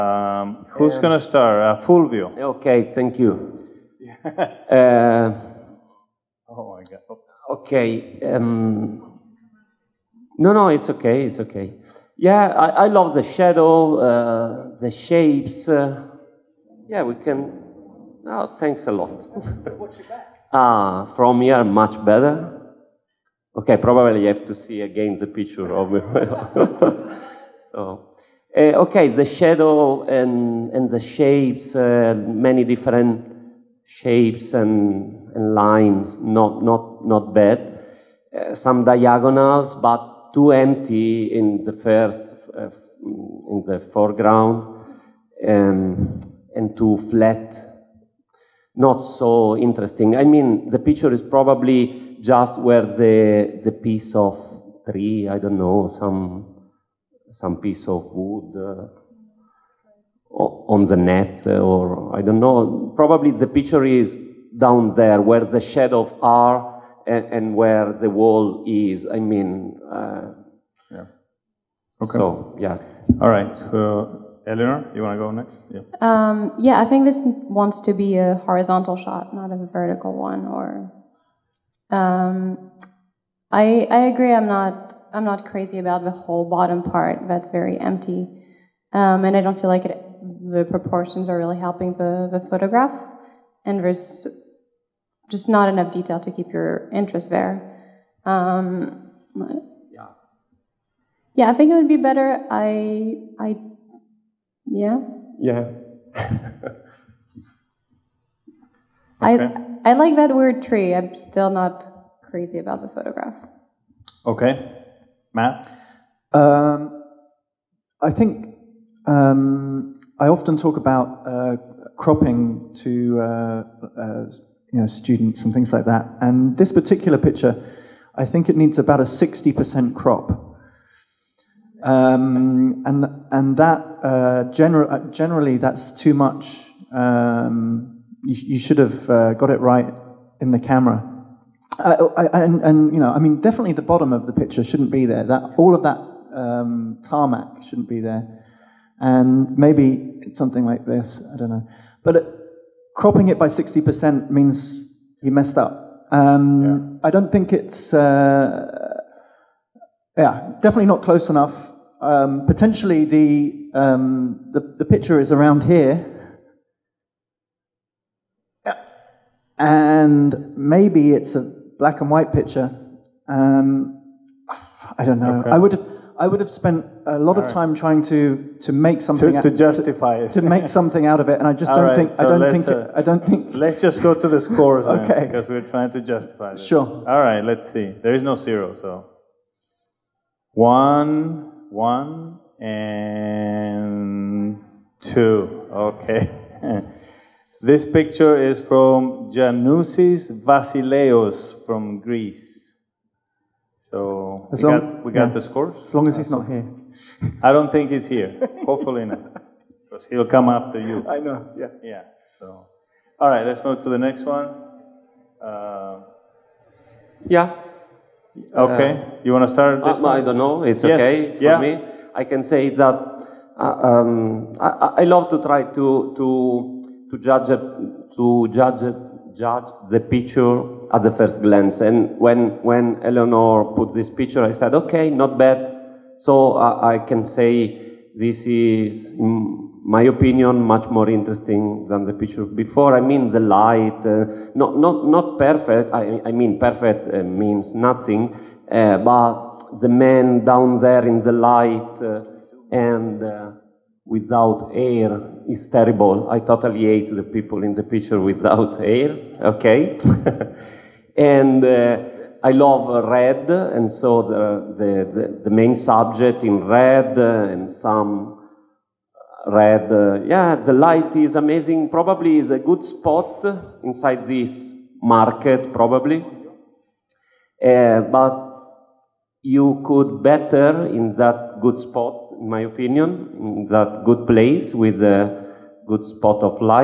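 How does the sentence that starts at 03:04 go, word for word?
okay, because we're trying to justify.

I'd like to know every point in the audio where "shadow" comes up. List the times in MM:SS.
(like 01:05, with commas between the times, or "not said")
00:13, 00:29, 01:05.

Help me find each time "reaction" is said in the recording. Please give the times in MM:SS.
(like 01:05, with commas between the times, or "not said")
not said.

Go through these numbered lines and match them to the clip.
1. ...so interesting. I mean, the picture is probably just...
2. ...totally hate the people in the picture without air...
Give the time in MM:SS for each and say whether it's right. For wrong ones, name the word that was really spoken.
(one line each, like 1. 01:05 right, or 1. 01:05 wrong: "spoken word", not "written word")
1. 00:49 right
2. 04:16 right.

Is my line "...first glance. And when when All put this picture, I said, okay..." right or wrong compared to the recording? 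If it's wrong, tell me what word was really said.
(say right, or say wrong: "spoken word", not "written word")
wrong: "Eleanor", not "All".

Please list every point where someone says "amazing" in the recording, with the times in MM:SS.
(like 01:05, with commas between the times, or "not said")
04:31.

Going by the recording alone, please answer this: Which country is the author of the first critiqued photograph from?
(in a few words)
Greece.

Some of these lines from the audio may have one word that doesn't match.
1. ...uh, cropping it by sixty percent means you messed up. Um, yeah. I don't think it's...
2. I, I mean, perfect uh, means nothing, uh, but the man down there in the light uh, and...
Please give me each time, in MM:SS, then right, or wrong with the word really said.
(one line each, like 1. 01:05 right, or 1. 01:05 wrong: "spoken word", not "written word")
1. 02:32 right
2. 04:05 right.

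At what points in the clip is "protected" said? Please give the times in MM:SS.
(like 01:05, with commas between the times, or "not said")
not said.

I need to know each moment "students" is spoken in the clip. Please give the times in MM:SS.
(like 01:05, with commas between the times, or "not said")
02:04.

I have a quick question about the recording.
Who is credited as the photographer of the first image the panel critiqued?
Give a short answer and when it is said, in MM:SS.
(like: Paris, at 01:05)
Giannousis Vasileios, at 03:19.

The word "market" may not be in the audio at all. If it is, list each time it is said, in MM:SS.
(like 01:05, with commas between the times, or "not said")
04:35.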